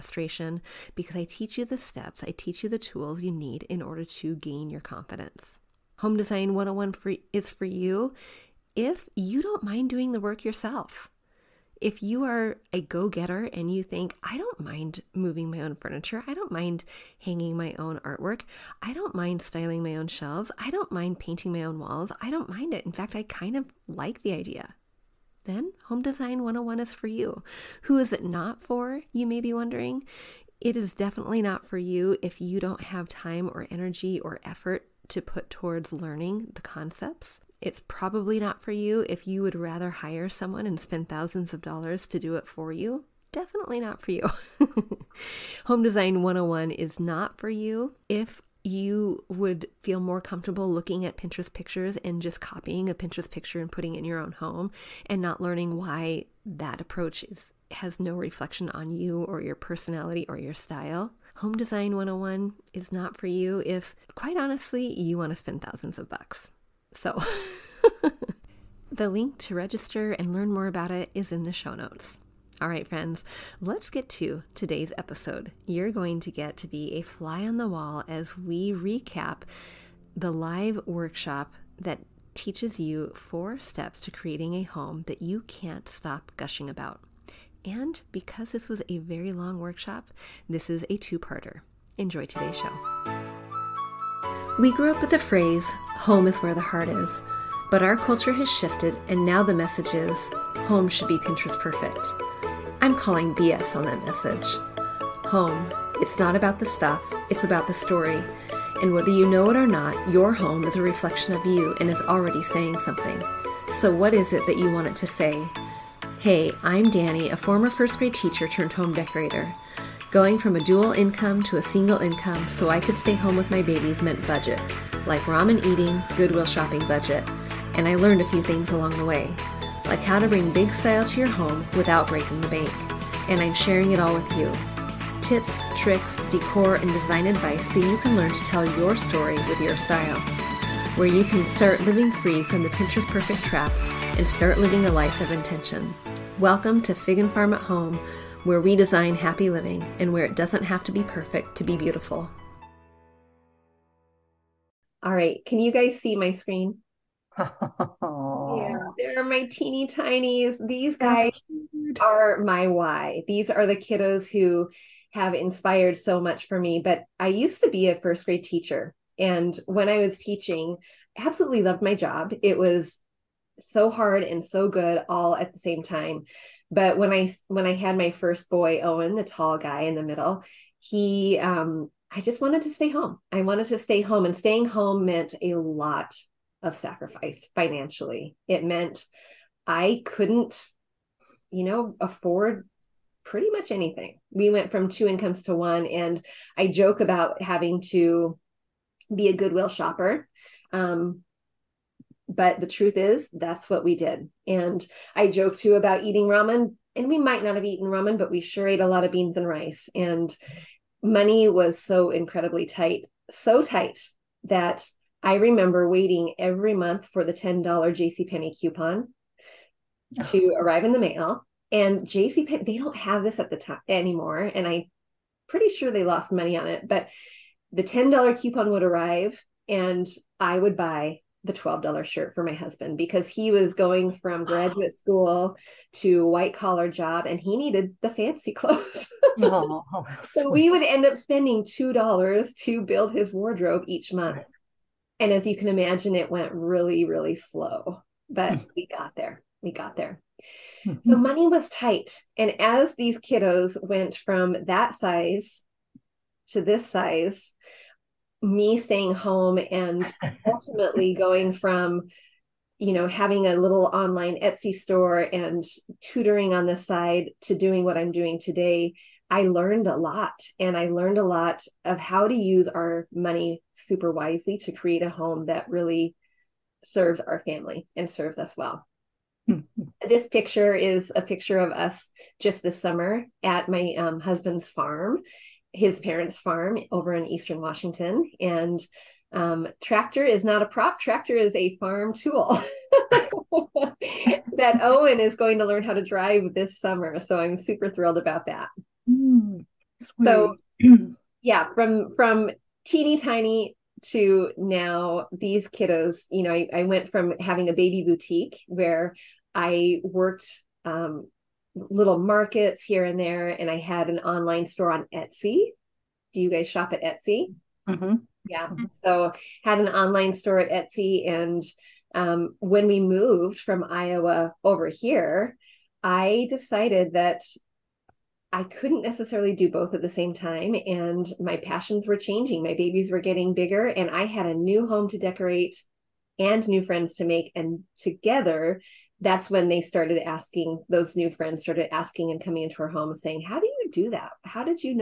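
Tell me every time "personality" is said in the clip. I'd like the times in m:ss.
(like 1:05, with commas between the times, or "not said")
0:59.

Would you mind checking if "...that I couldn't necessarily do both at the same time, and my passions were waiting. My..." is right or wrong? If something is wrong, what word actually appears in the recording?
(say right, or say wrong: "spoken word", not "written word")
wrong: "changing", not "waiting".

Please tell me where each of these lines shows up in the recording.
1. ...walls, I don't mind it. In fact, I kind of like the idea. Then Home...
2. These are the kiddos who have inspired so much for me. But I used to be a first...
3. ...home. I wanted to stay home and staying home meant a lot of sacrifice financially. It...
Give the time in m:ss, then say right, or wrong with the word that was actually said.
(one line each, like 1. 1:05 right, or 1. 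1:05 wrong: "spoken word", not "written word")
1. 0:21 right
2. 2:43 right
3. 3:02 right.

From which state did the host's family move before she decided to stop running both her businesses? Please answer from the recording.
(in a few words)
Iowa.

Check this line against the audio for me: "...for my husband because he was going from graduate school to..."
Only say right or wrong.
right.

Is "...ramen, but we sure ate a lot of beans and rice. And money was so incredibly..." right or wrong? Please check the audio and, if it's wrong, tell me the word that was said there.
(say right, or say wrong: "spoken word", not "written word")
right.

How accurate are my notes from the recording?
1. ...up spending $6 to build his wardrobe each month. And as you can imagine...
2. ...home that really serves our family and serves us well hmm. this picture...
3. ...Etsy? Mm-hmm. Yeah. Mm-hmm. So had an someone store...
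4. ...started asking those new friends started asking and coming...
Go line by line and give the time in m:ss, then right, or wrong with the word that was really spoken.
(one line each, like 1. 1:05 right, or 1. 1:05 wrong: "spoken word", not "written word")
1. 4:01 wrong: "2", not "6"
2. 4:35 right
3. 5:17 wrong: "online", not "someone"
4. 5:39 right.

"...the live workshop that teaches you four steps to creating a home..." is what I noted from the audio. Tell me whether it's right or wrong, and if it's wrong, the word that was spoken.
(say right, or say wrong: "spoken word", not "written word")
right.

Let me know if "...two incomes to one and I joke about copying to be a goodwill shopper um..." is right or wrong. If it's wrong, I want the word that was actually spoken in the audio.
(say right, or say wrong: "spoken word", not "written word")
wrong: "having", not "copying".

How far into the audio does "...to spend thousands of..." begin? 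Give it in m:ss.
1:05.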